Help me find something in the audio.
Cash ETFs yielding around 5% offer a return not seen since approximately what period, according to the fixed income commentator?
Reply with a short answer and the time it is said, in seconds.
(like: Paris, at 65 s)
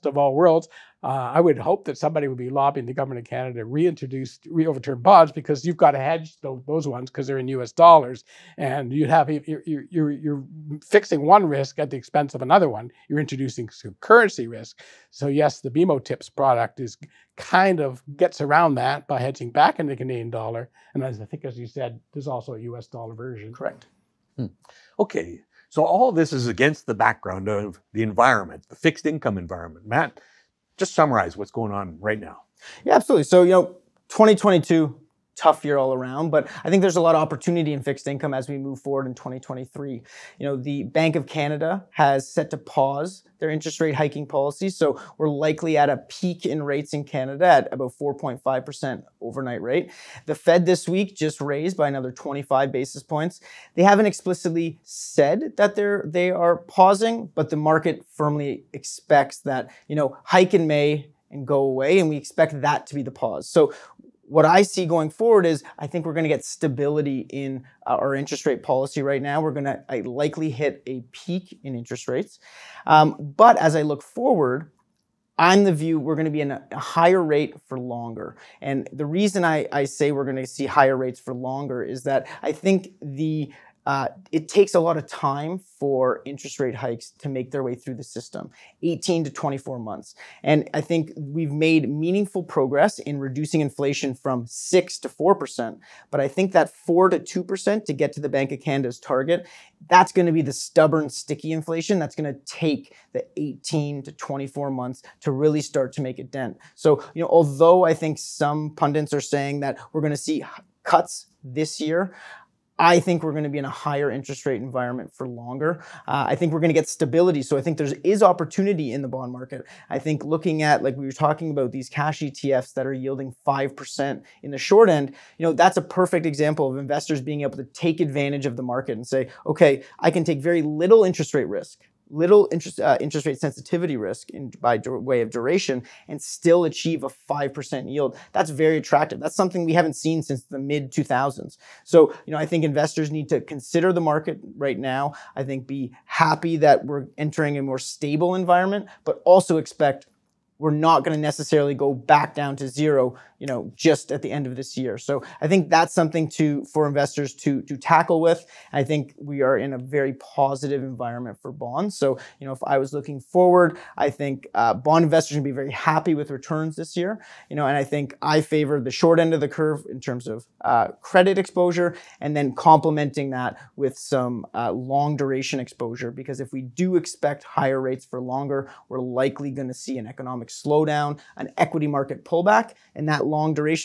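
mid 2000s, at 140 s.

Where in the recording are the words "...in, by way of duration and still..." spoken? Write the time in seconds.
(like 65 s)
134 s.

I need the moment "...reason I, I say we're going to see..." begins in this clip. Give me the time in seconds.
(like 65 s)
79 s.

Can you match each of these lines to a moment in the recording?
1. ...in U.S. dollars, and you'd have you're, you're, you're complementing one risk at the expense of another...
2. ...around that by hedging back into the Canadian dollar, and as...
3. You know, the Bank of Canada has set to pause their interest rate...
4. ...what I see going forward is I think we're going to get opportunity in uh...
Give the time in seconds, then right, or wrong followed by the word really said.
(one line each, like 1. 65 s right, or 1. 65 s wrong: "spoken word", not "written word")
1. 7 s wrong: "fixing", not "complementing"
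2. 18 s right
3. 40 s right
4. 64 s wrong: "stability", not "opportunity".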